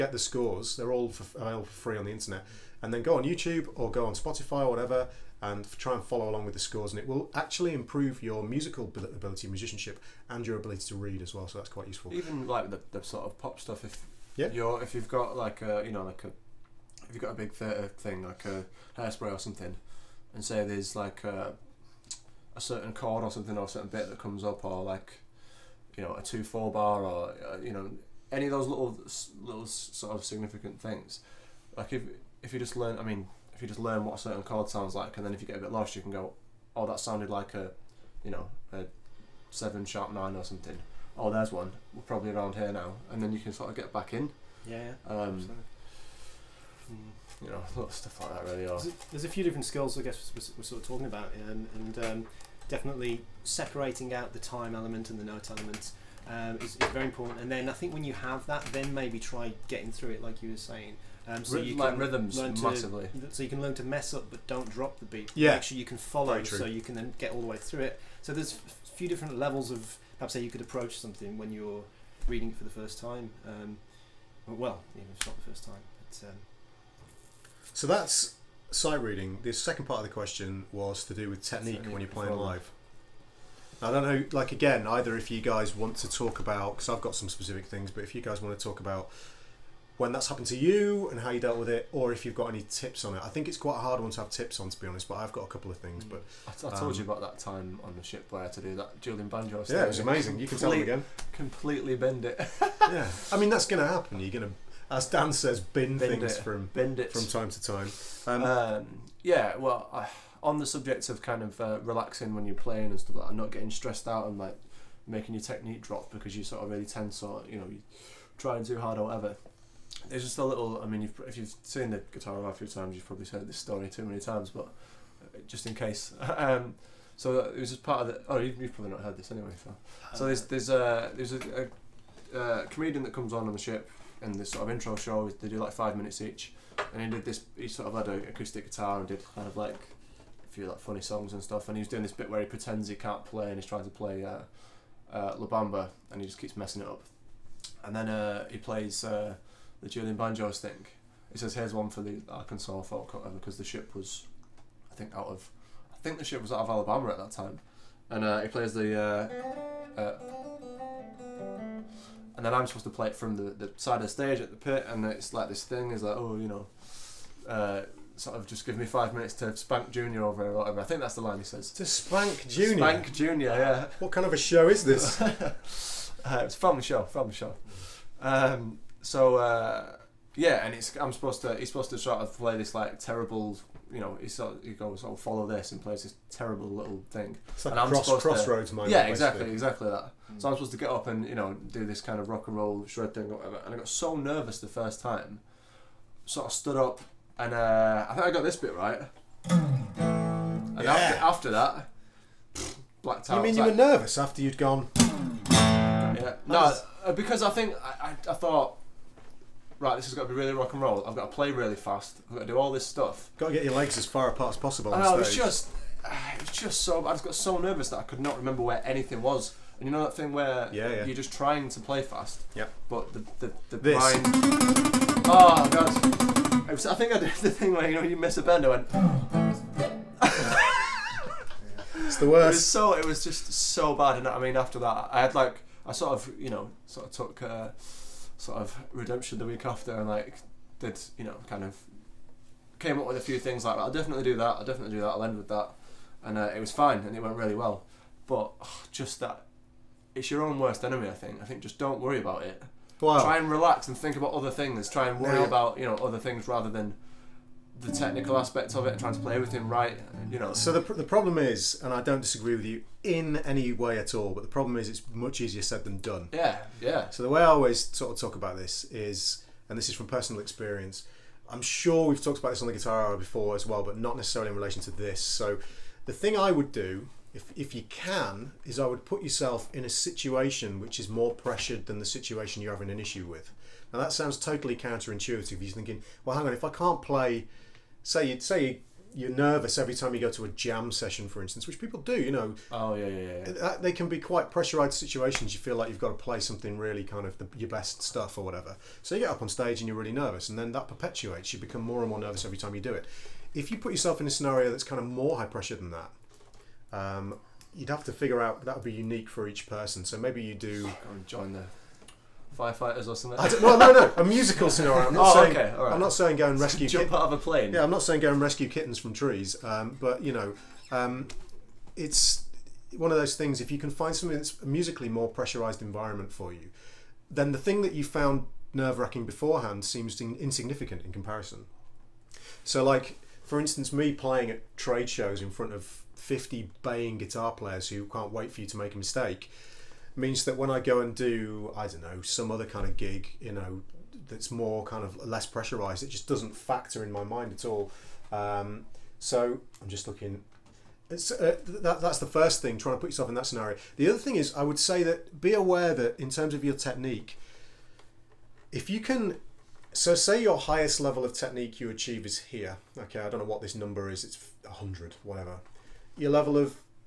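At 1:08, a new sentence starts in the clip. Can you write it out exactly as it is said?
So there's a few different levels of perhaps how you could approach something when you're reading it for the first time.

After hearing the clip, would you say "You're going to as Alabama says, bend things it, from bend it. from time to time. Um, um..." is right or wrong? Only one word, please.
wrong.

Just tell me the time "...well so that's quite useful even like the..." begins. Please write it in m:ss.
0:11.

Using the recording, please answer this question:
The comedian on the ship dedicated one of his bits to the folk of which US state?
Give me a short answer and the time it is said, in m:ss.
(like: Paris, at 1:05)
Arkansas, at 2:32.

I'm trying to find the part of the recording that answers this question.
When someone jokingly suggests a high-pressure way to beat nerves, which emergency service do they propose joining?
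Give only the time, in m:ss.
5:12.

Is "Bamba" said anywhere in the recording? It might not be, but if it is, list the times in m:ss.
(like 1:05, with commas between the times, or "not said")
2:25.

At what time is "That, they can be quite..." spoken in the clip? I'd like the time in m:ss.
4:53.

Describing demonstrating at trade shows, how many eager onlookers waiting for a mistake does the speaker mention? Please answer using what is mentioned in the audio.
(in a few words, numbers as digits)
50.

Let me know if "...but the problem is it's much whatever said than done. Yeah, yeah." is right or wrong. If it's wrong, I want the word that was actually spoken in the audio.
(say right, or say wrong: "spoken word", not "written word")
wrong: "easier", not "whatever".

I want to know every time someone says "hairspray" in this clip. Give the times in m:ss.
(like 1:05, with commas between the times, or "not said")
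0:18.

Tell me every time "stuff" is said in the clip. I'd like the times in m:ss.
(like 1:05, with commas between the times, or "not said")
0:13, 0:47, 1:53, 2:21, 3:32, 4:58.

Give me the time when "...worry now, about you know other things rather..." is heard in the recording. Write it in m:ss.
4:15.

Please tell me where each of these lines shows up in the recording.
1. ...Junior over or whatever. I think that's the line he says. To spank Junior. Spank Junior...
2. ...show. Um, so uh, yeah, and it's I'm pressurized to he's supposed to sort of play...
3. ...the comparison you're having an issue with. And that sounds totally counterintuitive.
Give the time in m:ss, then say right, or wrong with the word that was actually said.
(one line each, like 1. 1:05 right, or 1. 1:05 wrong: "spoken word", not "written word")
1. 2:49 right
2. 2:57 wrong: "supposed", not "pressurized"
3. 4:41 wrong: "situation", not "comparison".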